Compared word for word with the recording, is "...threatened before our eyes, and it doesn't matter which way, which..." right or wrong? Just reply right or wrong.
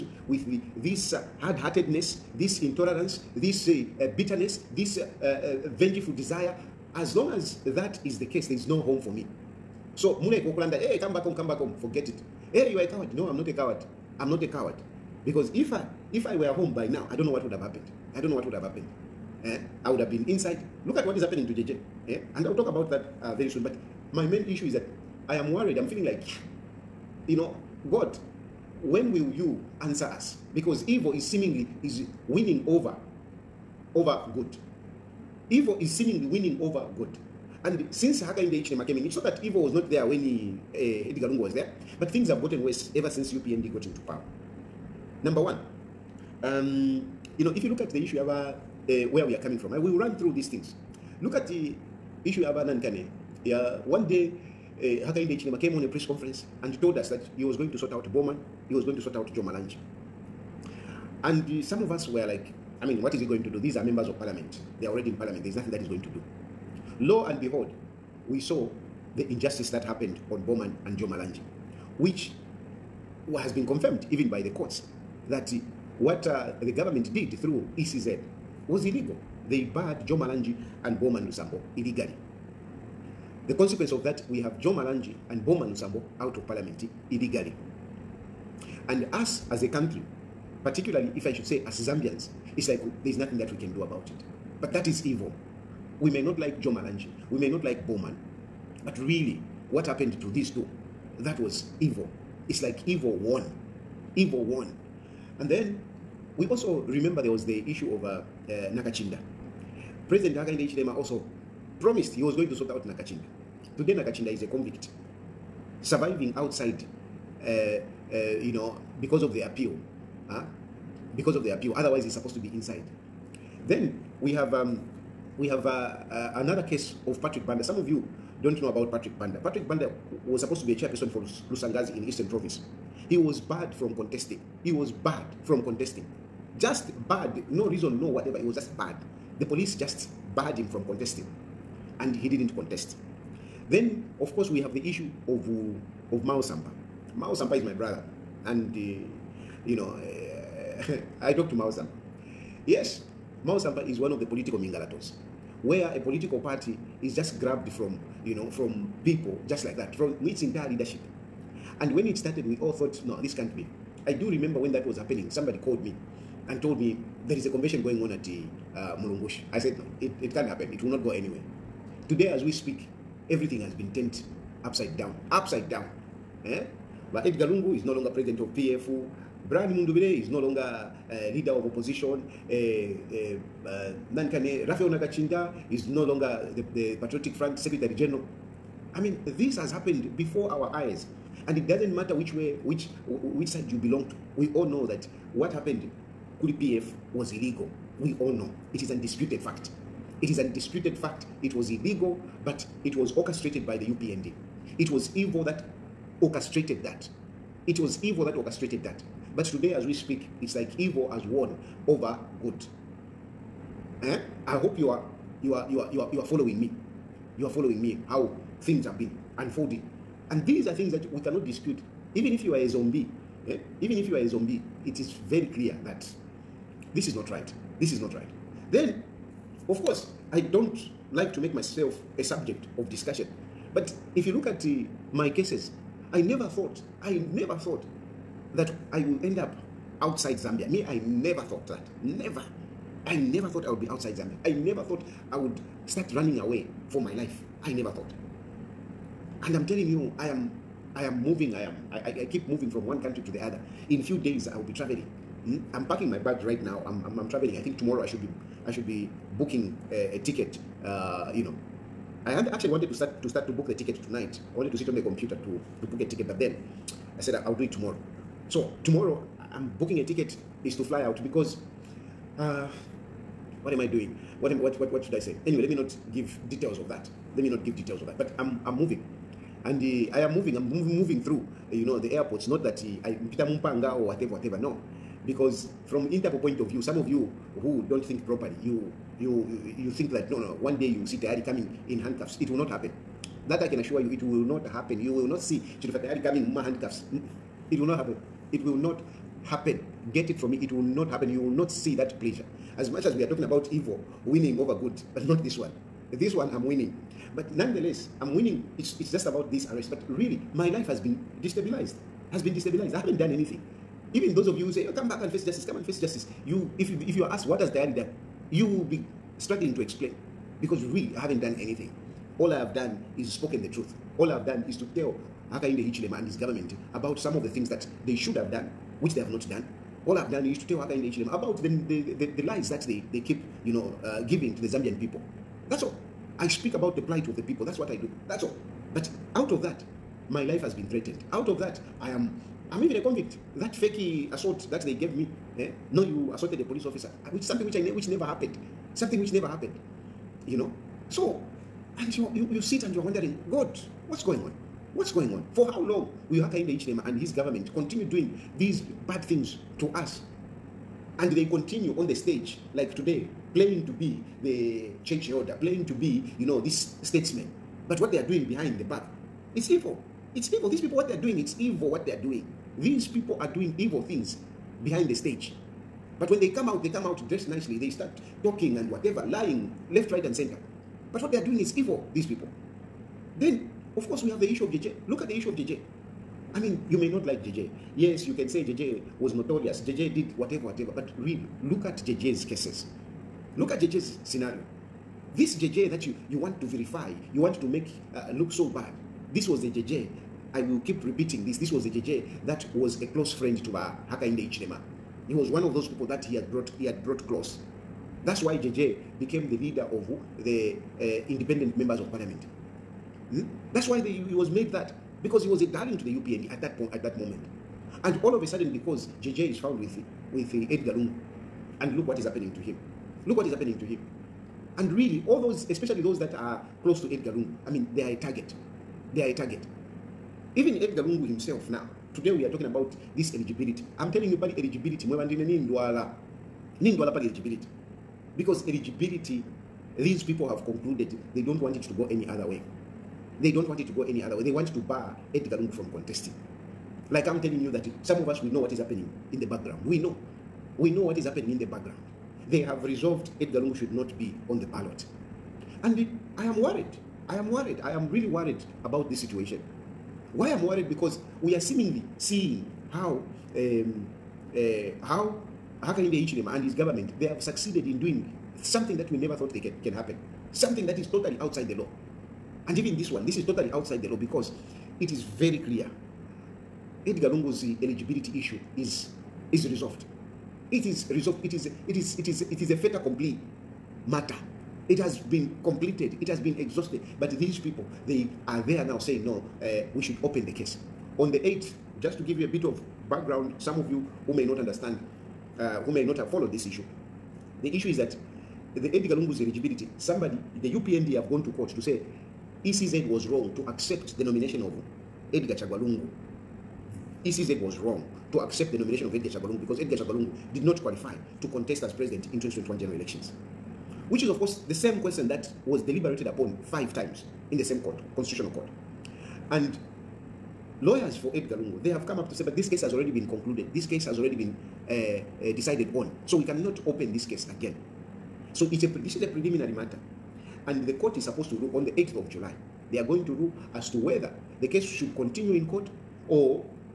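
wrong.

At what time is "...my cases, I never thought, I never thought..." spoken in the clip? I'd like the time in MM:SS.
03:55.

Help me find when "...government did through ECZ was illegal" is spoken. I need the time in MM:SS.
01:16.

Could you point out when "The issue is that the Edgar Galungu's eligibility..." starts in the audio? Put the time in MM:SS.
08:17.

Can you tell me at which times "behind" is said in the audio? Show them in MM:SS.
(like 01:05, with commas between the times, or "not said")
06:08, 06:14.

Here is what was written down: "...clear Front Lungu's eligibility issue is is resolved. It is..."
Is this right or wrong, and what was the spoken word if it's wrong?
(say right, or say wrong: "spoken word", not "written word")
wrong: "Edgar", not "Front".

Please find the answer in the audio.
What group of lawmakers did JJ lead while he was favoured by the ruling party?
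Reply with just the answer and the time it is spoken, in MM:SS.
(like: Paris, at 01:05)
Independent members of parliament, at 06:51.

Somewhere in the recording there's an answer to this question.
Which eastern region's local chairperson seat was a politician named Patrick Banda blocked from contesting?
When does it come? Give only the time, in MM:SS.
02:11.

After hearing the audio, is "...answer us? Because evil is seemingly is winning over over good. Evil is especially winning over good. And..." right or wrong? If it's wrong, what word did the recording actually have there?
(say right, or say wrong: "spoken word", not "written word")
wrong: "seemingly", not "especially".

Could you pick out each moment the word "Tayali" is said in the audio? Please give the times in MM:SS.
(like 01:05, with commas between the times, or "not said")
04:51, 04:56.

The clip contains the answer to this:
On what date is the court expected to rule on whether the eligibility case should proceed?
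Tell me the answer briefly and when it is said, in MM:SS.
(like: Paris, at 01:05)
8 July, at 08:51.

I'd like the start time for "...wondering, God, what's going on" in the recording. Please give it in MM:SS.
05:53.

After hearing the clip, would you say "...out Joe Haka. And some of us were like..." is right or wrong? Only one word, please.
wrong.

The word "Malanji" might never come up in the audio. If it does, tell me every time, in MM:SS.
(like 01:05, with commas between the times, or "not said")
00:59, 01:11, 01:20, 01:24, 01:36.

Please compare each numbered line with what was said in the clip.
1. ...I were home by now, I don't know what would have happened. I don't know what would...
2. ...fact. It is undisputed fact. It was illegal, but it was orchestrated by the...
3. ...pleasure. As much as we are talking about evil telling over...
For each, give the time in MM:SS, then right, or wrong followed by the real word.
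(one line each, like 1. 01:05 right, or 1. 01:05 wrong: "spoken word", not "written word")
1. 00:16 right
2. 03:19 right
3. 05:02 wrong: "winning", not "telling".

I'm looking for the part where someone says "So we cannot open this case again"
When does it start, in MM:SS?
08:46.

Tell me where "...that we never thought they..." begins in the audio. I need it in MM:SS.
07:48.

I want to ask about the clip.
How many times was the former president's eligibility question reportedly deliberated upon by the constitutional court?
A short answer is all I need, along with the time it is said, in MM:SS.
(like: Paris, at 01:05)
5, at 08:36.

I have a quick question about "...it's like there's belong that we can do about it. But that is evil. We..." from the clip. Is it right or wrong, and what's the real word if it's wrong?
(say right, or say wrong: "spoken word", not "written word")
wrong: "nothing", not "belong".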